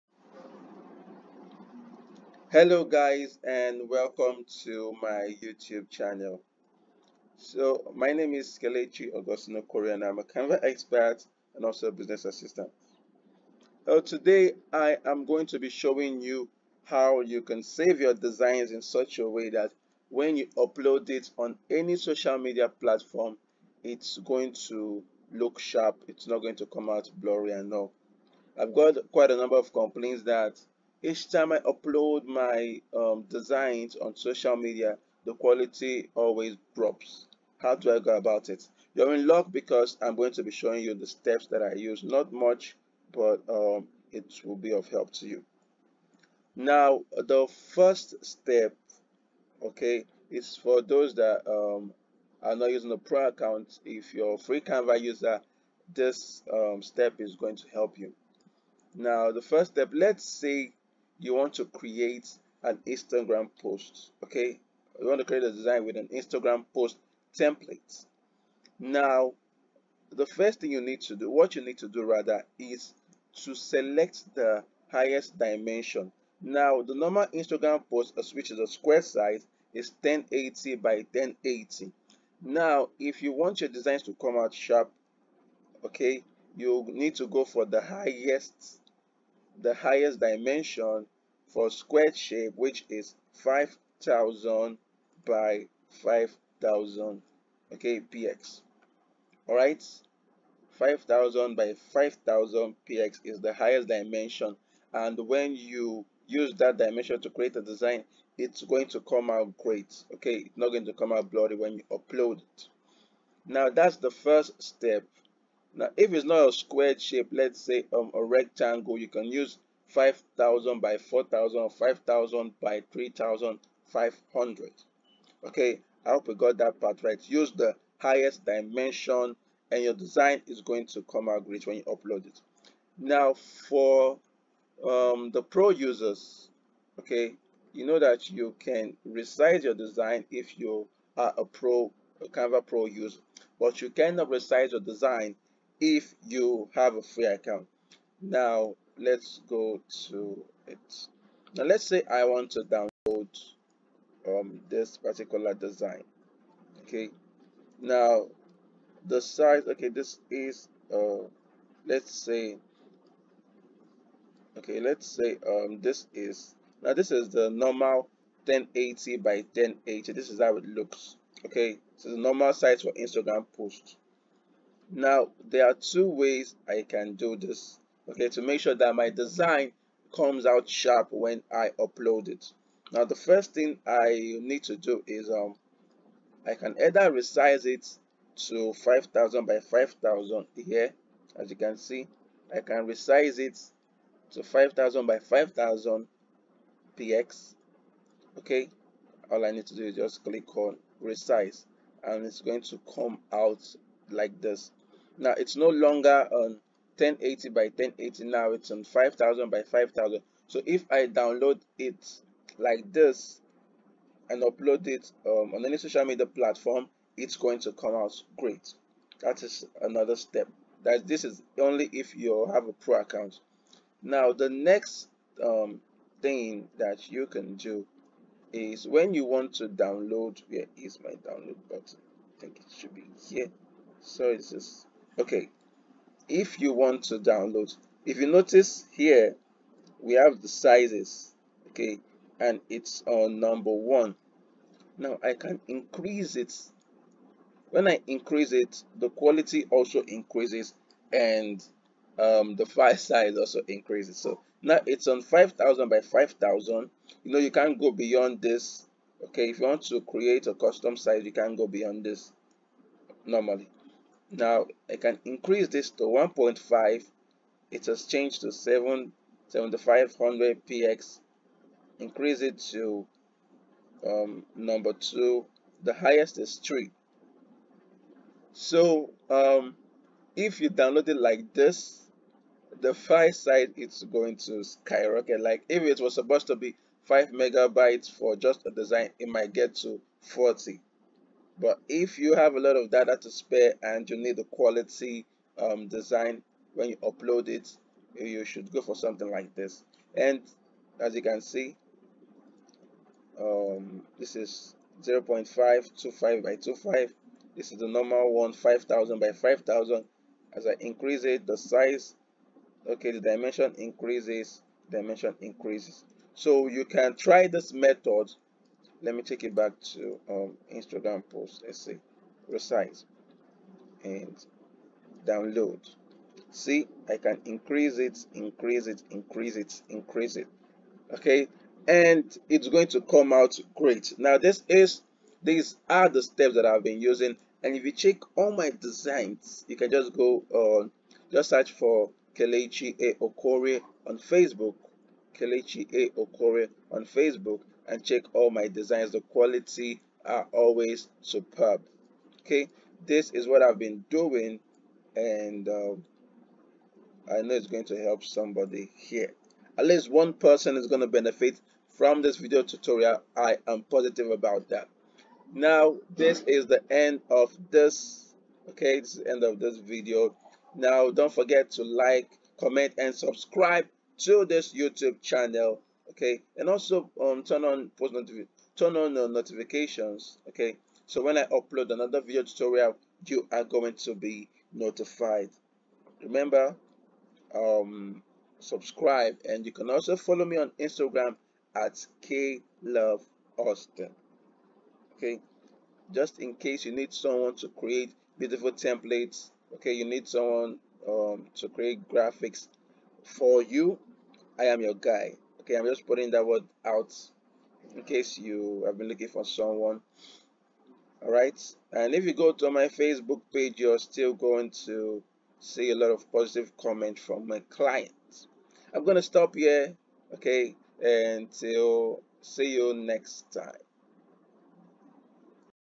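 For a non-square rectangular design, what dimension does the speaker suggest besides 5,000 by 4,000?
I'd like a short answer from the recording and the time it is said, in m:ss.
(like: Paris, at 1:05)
5,000 by 3,500, at 2:01.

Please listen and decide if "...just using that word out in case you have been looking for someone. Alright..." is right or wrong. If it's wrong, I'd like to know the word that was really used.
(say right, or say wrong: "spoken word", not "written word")
wrong: "putting", not "using".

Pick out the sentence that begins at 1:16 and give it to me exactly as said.
Now, the normal Instagram post, which is a square size, is 1080 by 1080.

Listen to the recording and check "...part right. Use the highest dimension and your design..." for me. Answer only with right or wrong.
right.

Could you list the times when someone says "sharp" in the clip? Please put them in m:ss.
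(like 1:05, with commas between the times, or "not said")
0:25, 1:24, 3:00.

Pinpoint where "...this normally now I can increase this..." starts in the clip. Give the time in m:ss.
4:22.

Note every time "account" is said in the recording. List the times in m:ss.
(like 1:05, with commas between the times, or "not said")
0:53, 2:27, 3:42.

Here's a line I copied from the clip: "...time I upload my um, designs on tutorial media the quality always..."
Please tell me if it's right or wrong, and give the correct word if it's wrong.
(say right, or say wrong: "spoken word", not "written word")
wrong: "social", not "tutorial".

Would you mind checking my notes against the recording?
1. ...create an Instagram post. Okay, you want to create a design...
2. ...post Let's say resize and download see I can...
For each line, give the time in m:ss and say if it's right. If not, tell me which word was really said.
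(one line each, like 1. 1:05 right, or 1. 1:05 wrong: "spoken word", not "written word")
1. 1:01 right
2. 5:21 right.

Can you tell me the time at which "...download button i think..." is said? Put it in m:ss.
3:51.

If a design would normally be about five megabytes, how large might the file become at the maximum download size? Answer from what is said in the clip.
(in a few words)
40 megabytes.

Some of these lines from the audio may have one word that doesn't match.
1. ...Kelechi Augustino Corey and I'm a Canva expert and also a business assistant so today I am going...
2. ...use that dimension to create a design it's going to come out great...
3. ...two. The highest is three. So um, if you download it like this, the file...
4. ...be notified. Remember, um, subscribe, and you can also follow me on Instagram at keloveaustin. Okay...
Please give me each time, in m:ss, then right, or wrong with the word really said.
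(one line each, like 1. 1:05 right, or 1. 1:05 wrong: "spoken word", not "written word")
1. 0:08 right
2. 1:46 right
3. 4:34 right
4. 6:24 right.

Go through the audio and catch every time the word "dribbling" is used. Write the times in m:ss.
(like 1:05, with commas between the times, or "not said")
not said.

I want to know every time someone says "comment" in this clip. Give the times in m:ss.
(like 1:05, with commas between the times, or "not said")
6:12, 6:56.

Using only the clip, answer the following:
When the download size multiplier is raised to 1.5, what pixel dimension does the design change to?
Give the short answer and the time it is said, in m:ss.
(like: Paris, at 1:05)
7500 px, at 4:29.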